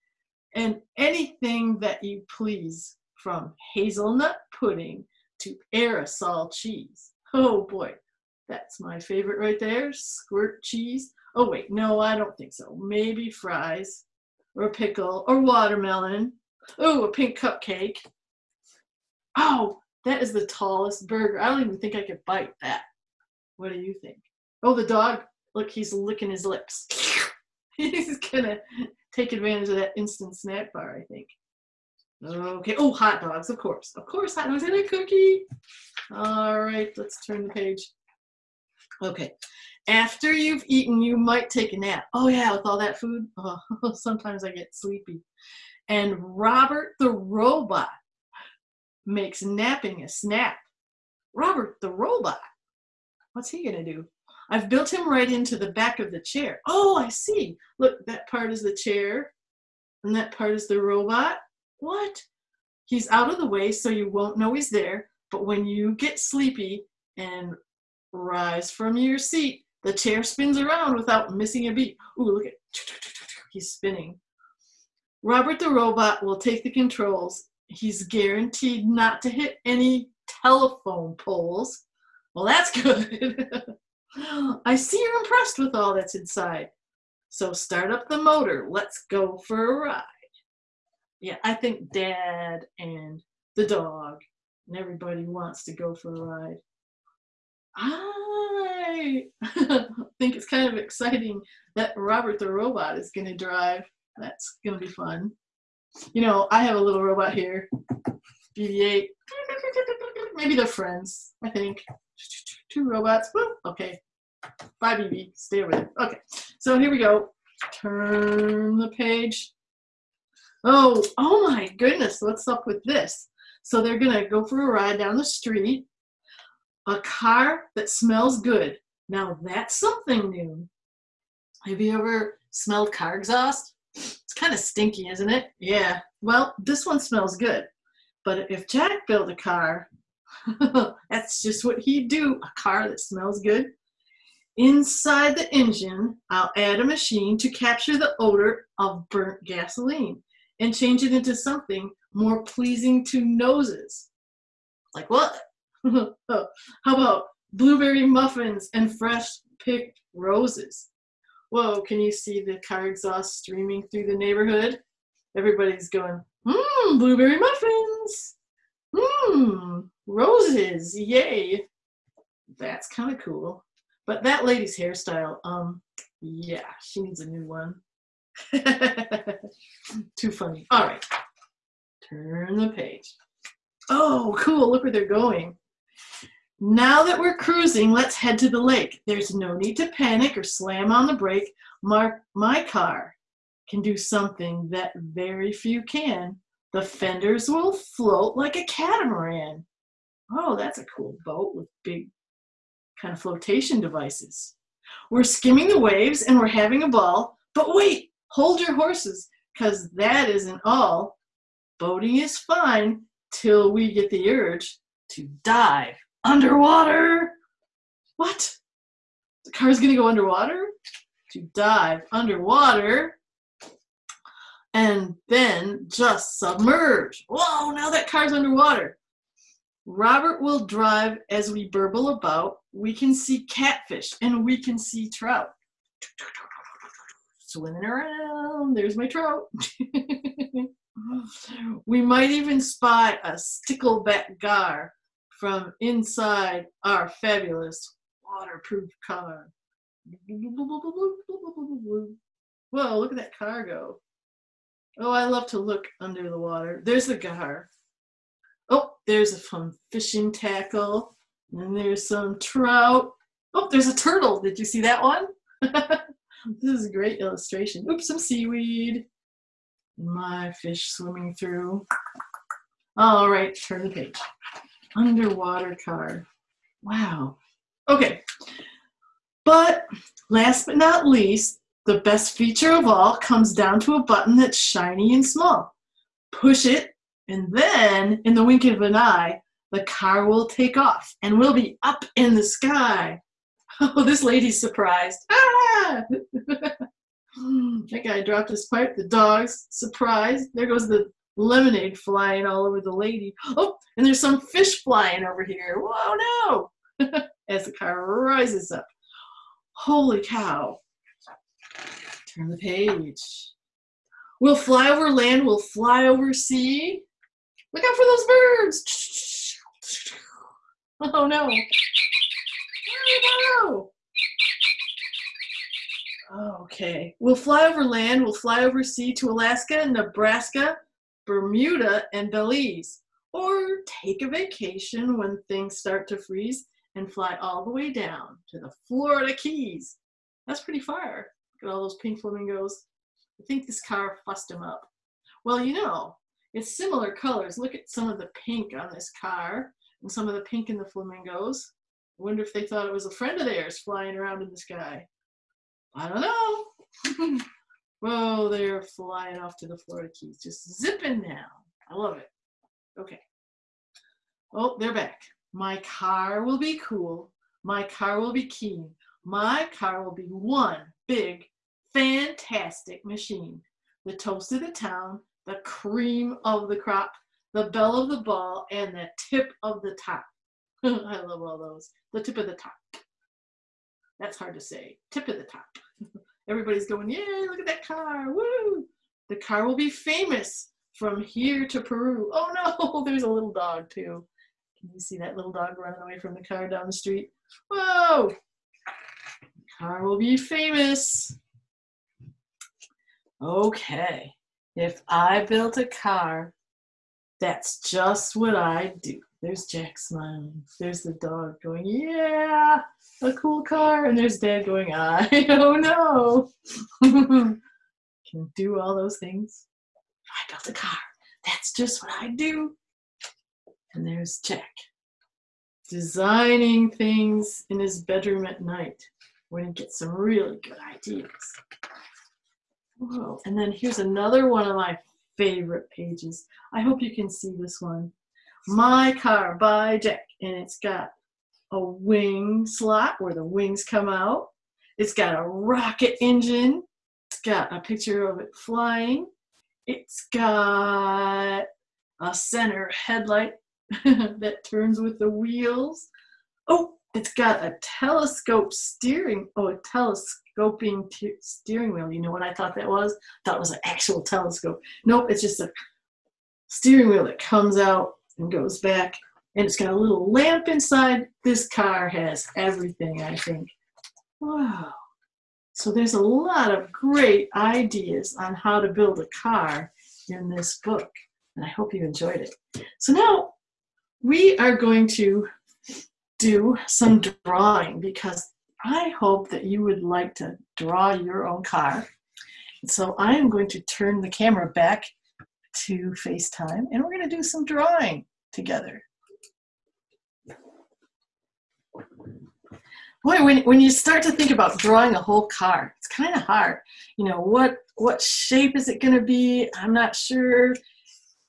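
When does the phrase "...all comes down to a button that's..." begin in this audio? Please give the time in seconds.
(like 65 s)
282 s.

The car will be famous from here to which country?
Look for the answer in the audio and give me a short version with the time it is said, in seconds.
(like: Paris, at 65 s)
Peru, at 391 s.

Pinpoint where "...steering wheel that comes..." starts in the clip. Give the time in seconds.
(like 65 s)
466 s.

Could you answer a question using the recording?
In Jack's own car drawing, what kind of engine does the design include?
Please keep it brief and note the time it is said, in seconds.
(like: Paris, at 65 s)
rocket engine, at 445 s.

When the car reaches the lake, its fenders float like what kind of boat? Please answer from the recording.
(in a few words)
catamaran.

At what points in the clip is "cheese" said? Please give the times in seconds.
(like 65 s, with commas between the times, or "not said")
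6 s, 10 s.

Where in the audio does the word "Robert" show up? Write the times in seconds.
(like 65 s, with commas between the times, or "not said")
46 s, 51 s, 75 s, 101 s, 229 s.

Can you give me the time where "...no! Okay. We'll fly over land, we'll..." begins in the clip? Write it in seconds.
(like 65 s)
326 s.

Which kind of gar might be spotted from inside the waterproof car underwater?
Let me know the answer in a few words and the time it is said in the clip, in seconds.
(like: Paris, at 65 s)
stickleback gar, at 243 s.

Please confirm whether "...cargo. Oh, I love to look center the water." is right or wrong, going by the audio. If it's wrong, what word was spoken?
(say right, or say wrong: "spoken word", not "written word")
wrong: "under", not "center".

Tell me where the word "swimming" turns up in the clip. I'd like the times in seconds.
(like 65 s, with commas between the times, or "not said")
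237 s, 270 s.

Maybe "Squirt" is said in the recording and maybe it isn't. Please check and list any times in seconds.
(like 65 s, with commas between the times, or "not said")
9 s.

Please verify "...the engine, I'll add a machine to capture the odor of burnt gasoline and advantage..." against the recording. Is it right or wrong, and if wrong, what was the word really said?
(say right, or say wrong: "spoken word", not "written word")
wrong: "change", not "advantage".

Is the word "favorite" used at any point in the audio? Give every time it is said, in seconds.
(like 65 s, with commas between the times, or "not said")
8 s, 435 s.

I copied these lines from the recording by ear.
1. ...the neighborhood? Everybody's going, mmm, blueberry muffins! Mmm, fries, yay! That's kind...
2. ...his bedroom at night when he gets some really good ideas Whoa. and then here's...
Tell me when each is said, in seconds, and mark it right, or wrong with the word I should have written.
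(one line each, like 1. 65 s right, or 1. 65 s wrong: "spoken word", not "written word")
1. 164 s wrong: "roses", not "fries"
2. 427 s right.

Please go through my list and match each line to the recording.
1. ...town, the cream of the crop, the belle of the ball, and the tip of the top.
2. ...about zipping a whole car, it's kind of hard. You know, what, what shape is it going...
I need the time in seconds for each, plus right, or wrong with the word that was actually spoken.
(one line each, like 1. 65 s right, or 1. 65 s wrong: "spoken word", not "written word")
1. 374 s right
2. 504 s wrong: "drawing", not "zipping".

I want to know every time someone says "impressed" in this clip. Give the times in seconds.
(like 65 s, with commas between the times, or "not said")
85 s.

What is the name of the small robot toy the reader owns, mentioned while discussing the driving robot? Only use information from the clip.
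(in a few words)
BB-8.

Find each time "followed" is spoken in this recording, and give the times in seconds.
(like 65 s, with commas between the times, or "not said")
not said.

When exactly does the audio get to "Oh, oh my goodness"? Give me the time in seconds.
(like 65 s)
120 s.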